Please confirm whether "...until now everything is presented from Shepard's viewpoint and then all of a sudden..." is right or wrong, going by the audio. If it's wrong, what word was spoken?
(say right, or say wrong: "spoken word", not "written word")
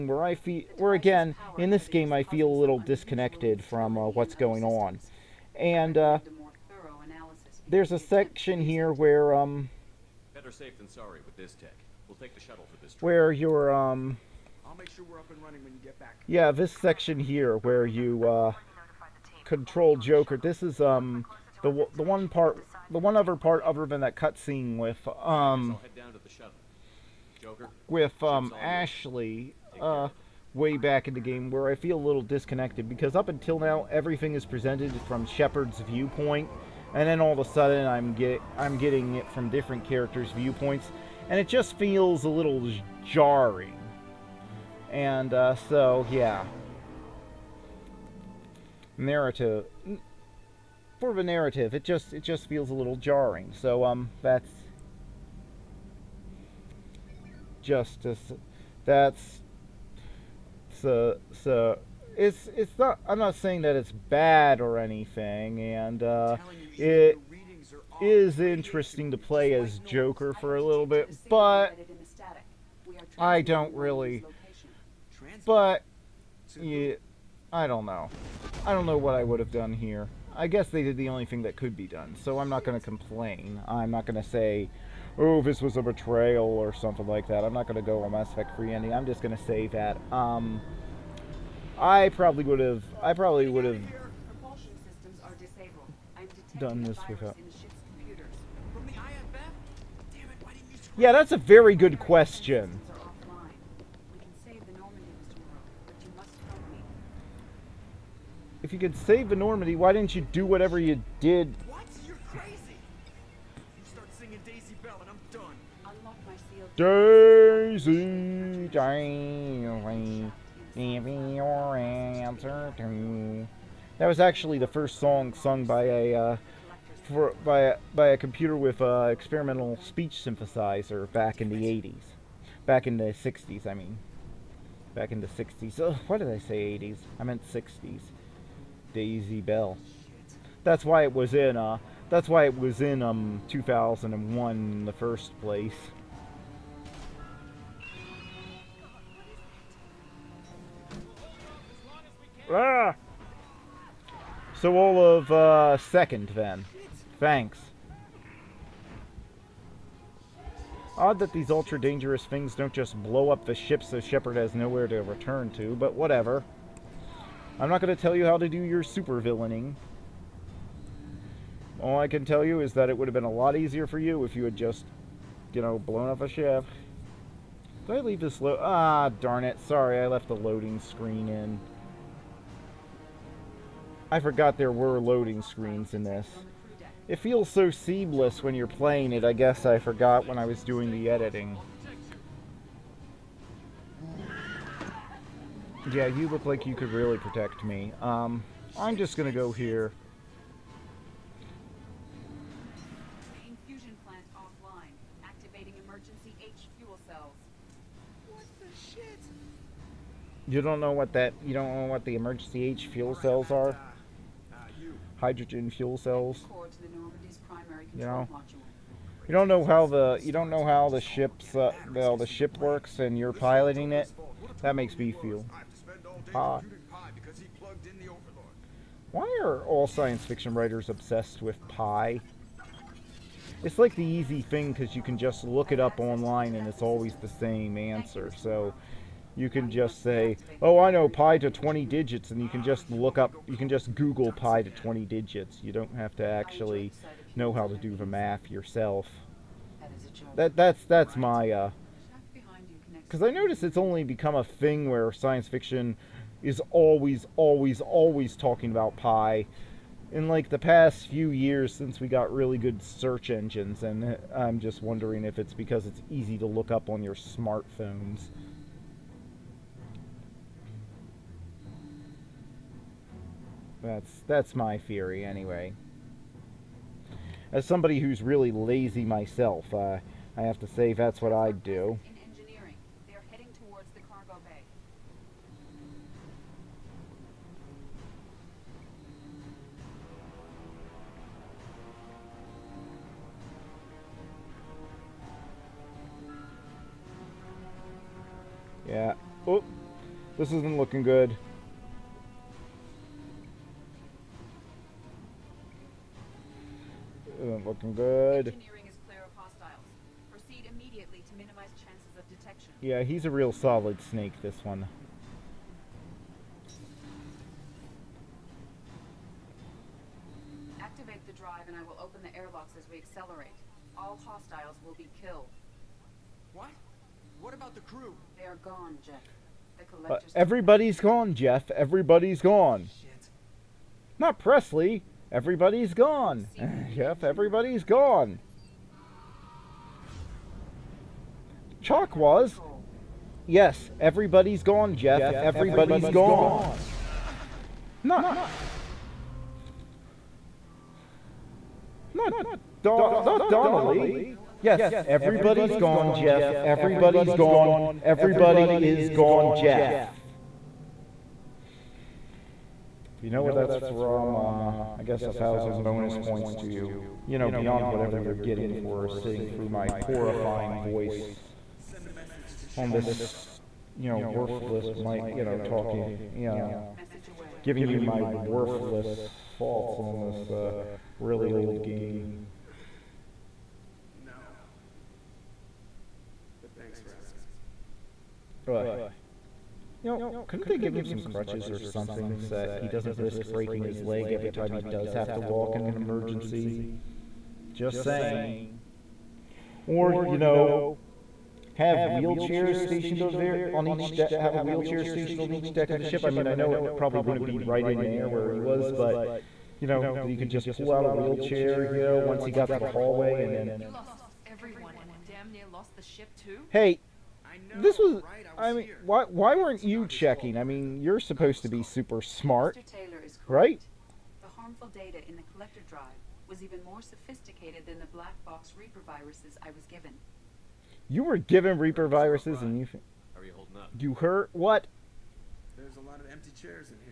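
right.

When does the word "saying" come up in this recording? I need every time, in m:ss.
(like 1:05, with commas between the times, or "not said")
1:03, 6:38.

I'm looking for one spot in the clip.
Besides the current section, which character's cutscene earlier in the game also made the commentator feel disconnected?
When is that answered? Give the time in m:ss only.
0:28.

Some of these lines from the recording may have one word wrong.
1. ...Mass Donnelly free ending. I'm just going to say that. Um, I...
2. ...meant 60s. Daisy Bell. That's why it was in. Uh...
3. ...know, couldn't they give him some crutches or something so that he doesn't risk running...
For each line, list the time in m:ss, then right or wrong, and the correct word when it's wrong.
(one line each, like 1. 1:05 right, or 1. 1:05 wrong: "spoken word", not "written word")
1. 1:28 wrong: "Effect", not "Donnelly"
2. 2:17 right
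3. 6:30 wrong: "breaking", not "running".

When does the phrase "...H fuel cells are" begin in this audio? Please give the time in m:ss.
3:32.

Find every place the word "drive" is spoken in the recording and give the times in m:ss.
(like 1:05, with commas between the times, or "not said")
5:21, 7:05.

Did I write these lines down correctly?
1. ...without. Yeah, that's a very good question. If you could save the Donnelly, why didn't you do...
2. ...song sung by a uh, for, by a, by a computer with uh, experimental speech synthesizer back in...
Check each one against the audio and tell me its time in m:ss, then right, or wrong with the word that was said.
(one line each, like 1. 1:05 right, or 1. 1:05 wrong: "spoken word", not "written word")
1. 1:37 wrong: "Normandy", not "Donnelly"
2. 2:04 right.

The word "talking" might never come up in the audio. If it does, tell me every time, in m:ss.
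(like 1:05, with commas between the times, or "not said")
4:18, 6:15.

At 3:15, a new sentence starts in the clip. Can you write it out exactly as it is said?
Yeah, you look like you could really protect me.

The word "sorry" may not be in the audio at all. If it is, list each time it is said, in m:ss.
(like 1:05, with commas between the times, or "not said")
0:10, 2:59.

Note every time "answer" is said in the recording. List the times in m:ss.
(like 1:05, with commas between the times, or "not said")
2:01, 3:57.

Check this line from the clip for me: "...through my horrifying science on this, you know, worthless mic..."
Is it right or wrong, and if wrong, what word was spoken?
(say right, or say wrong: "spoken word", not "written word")
wrong: "voice", not "science".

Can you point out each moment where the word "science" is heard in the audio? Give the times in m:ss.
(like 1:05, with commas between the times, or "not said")
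3:49, 4:15.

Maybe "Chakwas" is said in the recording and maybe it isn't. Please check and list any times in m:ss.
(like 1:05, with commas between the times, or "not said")
5:41.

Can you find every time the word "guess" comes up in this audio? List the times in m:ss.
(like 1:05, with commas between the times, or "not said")
1:20, 3:09, 6:05.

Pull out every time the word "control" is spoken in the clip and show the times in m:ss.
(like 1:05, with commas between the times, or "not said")
0:19.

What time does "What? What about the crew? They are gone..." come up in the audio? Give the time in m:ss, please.
5:26.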